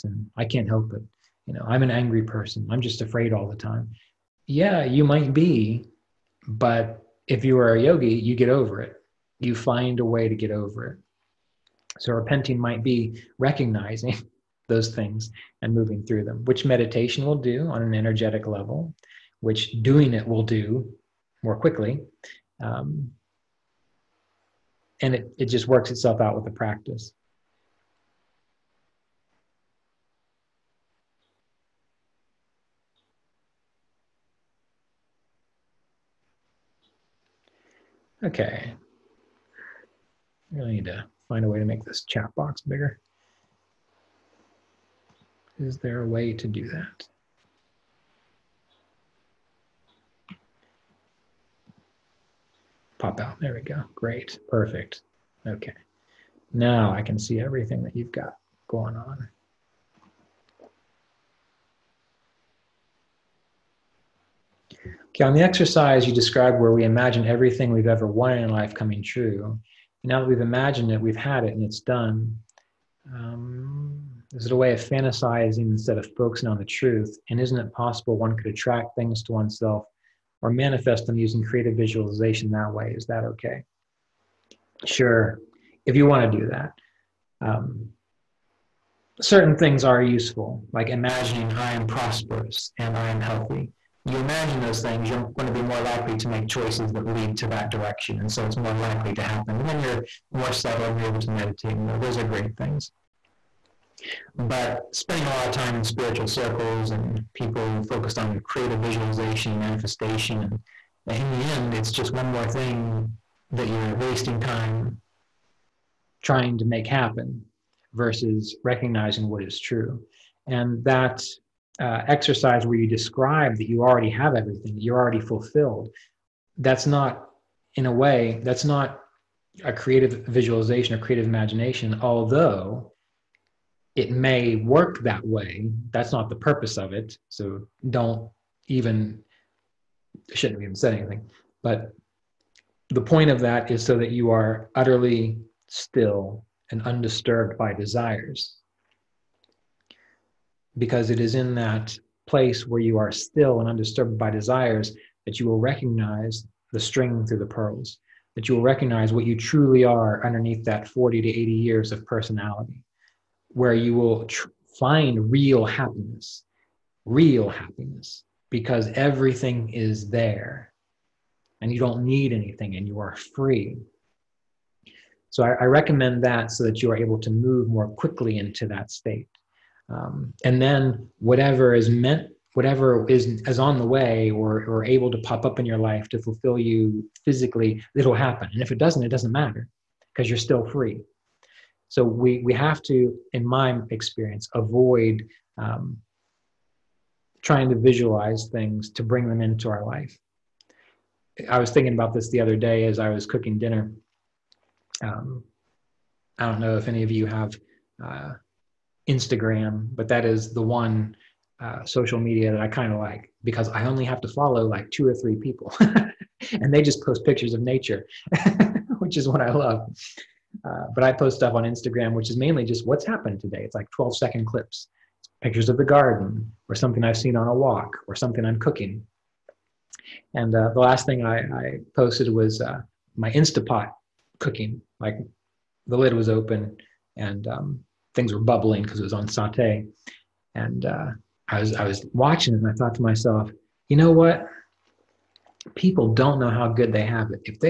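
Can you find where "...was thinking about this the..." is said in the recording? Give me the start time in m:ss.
3:21.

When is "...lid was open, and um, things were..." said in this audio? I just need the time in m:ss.
3:55.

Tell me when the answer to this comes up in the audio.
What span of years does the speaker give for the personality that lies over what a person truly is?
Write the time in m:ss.
2:40.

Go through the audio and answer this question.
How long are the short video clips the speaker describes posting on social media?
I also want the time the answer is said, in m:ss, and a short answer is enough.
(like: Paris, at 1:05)
12 seconds, at 3:43.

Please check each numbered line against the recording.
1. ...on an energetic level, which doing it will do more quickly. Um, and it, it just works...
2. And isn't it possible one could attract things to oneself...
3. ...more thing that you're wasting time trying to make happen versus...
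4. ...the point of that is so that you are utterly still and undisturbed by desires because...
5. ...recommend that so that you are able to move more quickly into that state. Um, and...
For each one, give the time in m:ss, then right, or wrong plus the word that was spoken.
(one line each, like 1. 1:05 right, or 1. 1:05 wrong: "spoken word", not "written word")
1. 0:17 right
2. 1:17 right
3. 1:52 right
4. 2:22 right
5. 2:55 right.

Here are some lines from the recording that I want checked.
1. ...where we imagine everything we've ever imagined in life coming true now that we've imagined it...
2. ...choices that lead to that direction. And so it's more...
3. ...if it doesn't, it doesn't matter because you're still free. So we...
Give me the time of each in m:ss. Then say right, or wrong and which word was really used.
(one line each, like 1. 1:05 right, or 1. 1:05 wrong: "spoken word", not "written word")
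1. 1:06 wrong: "wanted", not "imagined"
2. 1:36 right
3. 3:08 right.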